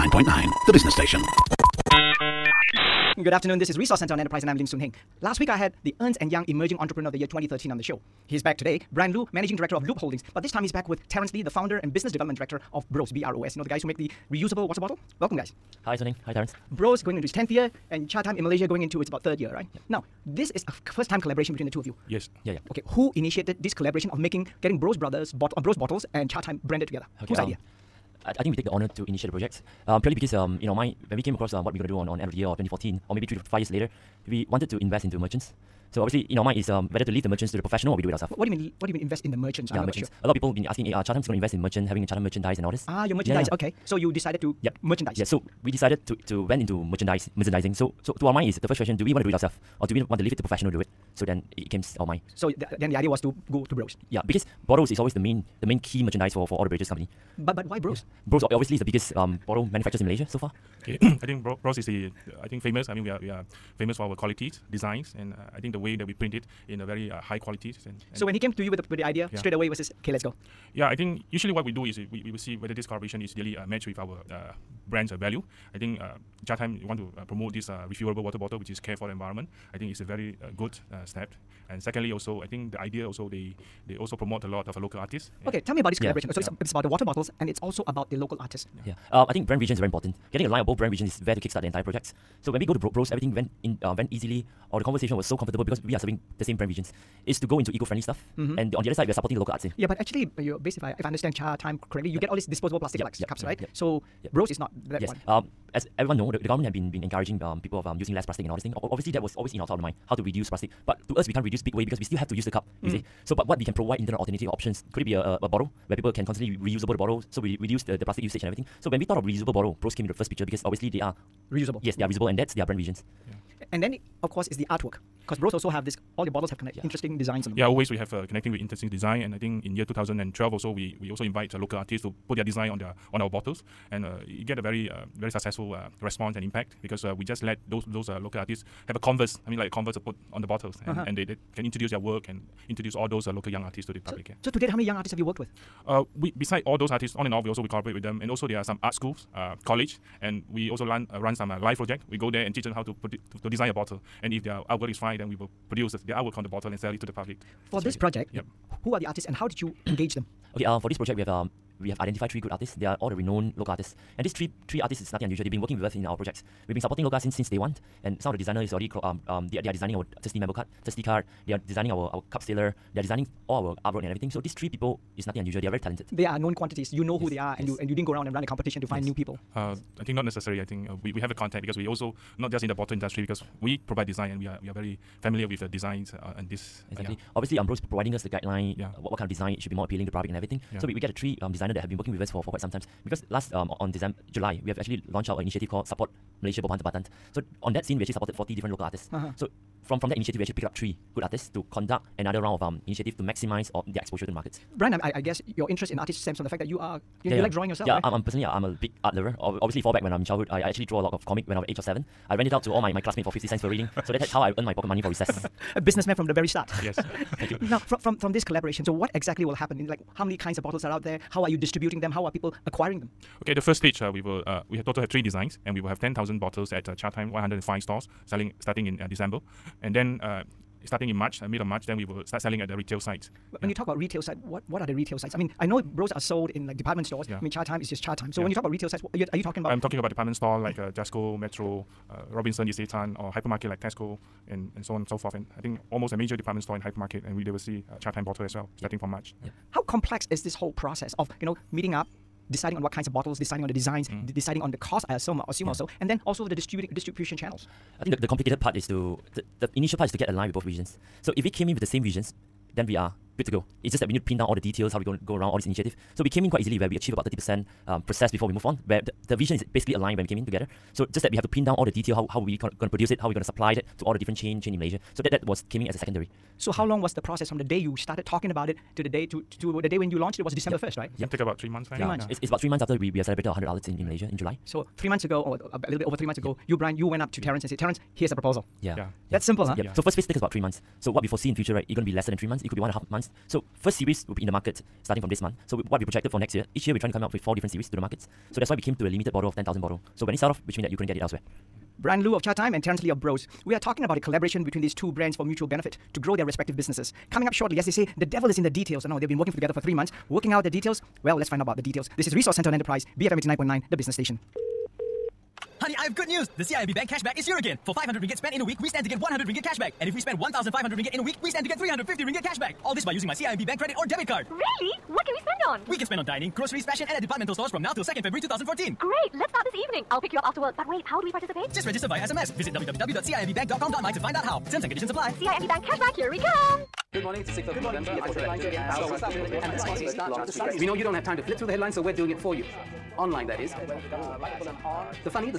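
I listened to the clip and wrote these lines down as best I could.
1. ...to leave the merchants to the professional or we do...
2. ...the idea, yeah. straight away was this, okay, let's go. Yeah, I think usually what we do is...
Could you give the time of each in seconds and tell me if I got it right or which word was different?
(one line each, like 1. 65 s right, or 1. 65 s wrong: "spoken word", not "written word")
1. 37 s right
2. 68 s right.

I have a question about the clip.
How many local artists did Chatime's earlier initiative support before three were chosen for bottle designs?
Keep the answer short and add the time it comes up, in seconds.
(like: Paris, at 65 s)
40, at 198 s.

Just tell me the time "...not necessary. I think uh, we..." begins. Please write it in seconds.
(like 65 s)
180 s.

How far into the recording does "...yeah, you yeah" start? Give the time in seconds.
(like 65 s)
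207 s.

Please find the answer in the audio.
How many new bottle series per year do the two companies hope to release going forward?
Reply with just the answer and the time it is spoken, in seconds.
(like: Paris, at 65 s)
4, at 297 s.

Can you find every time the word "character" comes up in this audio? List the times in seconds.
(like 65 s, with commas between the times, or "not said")
not said.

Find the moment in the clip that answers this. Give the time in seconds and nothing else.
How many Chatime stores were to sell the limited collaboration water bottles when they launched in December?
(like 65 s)
227 s.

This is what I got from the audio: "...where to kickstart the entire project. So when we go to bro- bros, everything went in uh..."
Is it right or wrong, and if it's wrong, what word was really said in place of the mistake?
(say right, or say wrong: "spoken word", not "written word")
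right.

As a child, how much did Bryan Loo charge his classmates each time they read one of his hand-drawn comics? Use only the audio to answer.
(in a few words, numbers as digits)
50 cents.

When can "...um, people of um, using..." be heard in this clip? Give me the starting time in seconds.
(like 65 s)
107 s.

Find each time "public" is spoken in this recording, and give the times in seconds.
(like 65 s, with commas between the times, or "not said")
143 s, 157 s, 190 s.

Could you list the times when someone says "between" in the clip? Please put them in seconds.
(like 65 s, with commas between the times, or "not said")
21 s, 304 s.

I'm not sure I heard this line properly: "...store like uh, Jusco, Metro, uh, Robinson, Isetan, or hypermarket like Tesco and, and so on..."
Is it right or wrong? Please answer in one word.
right.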